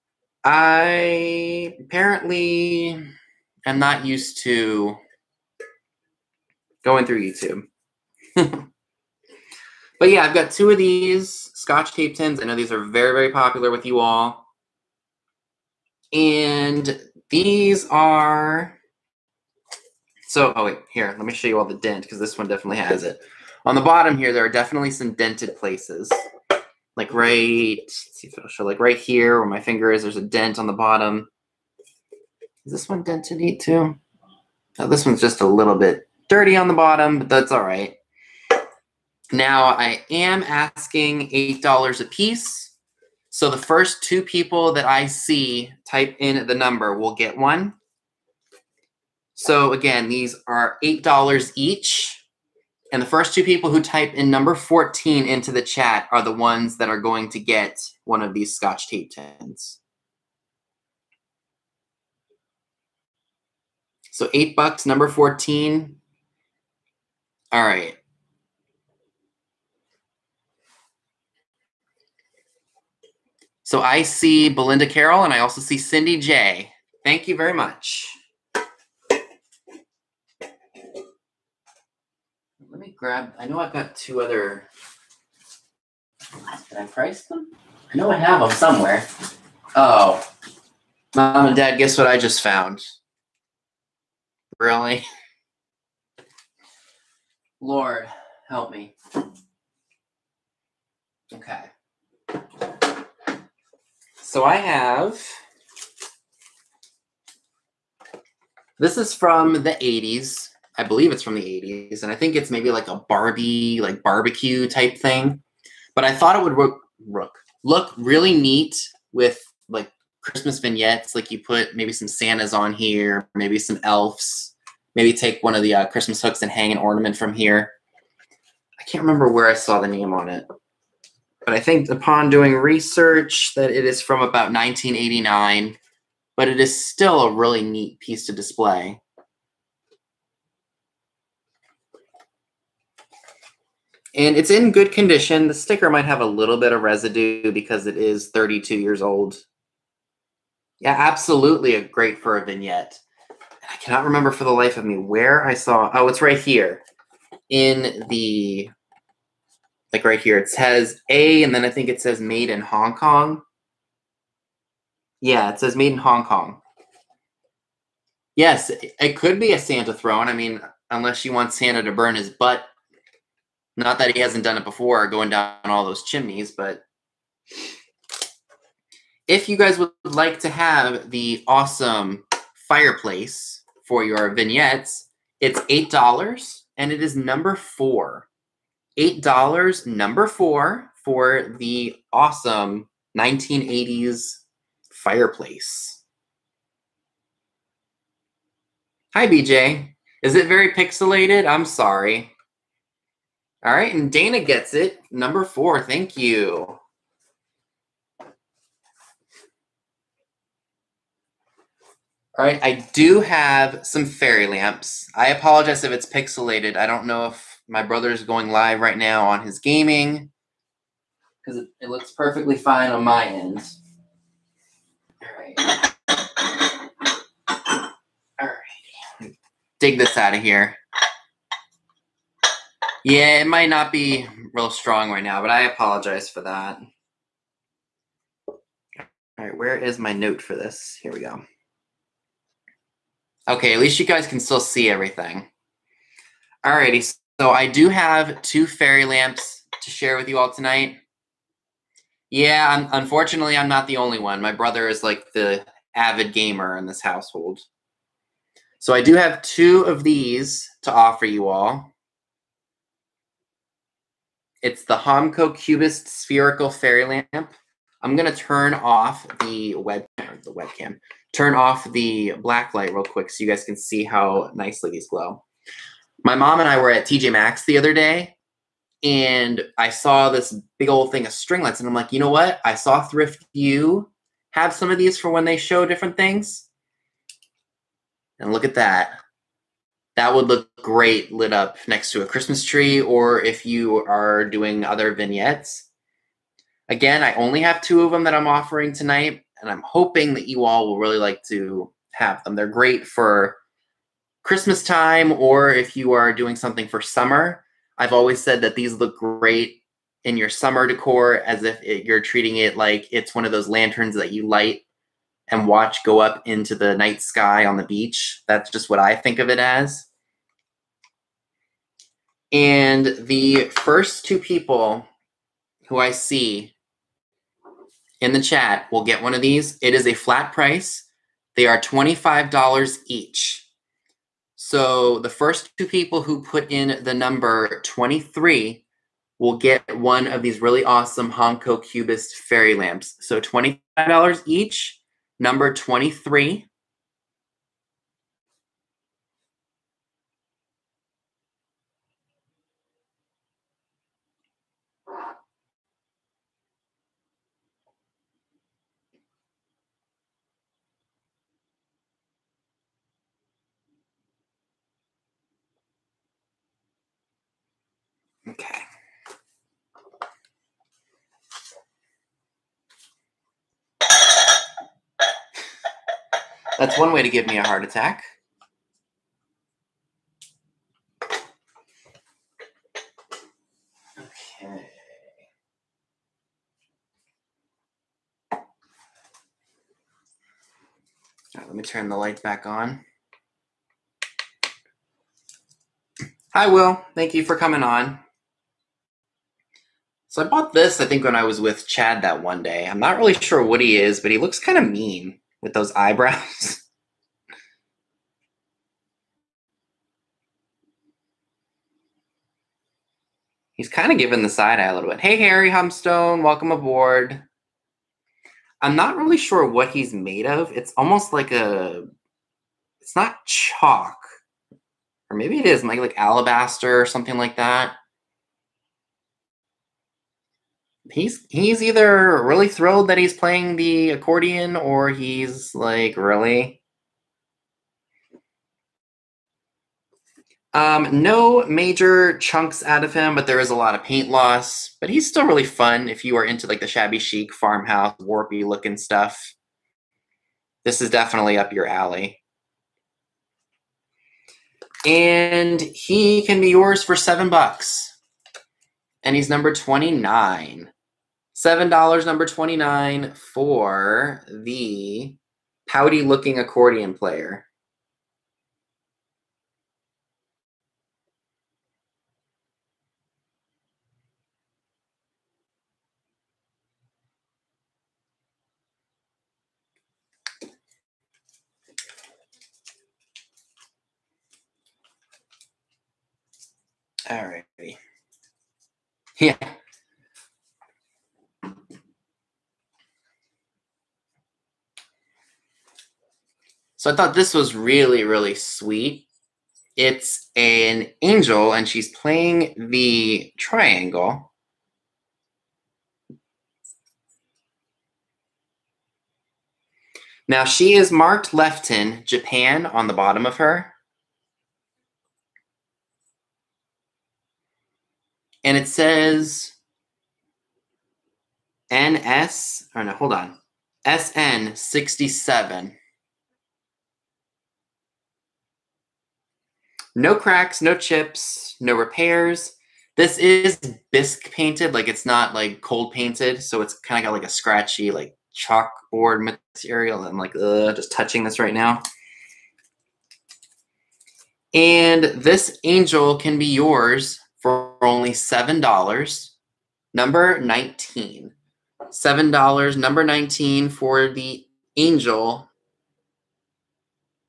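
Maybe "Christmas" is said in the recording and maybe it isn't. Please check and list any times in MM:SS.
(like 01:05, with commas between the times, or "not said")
02:00, 02:05, 04:52, 05:04.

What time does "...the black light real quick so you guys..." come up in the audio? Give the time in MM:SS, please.
04:31.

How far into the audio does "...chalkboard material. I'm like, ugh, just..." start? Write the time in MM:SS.
08:58.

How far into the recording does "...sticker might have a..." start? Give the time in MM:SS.
02:25.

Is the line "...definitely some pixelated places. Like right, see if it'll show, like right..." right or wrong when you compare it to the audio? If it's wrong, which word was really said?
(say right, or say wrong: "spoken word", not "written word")
wrong: "dented", not "pixelated".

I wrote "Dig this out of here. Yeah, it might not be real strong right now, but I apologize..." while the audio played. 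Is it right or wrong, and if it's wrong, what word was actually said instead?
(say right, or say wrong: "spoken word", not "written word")
right.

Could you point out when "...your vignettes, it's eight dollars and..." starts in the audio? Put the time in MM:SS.
03:04.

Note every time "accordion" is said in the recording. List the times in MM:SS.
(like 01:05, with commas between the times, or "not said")
07:14, 07:46.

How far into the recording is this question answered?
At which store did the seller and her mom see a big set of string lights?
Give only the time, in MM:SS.
04:37.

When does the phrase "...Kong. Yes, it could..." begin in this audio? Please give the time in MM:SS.
02:46.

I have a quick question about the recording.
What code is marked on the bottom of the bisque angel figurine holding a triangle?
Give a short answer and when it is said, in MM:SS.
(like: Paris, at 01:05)
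SN67, at 08:44.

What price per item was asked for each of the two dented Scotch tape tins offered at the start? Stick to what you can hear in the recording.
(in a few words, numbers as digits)
$8.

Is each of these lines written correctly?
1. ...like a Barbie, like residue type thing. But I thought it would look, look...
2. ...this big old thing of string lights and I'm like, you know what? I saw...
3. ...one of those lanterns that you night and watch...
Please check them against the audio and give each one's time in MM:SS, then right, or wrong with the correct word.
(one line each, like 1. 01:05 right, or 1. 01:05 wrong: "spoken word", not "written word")
1. 01:52 wrong: "barbecue", not "residue"
2. 04:40 right
3. 05:13 wrong: "light", not "night".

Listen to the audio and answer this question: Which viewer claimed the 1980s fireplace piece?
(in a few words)
Dana.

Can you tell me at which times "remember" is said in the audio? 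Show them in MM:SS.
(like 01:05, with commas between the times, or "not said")
02:09, 02:34.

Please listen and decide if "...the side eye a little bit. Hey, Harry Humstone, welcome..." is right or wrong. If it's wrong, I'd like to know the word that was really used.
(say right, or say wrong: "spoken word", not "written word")
right.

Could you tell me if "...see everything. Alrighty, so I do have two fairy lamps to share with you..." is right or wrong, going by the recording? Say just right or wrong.
right.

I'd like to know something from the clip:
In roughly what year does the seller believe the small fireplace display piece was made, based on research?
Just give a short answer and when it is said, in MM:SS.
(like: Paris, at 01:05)
1989, at 02:14.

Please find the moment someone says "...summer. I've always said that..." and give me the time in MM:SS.
05:07.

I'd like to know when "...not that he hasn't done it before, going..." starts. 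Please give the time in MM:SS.
02:53.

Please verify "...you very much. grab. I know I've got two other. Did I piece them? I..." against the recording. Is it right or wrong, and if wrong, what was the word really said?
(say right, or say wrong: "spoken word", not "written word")
wrong: "price", not "piece".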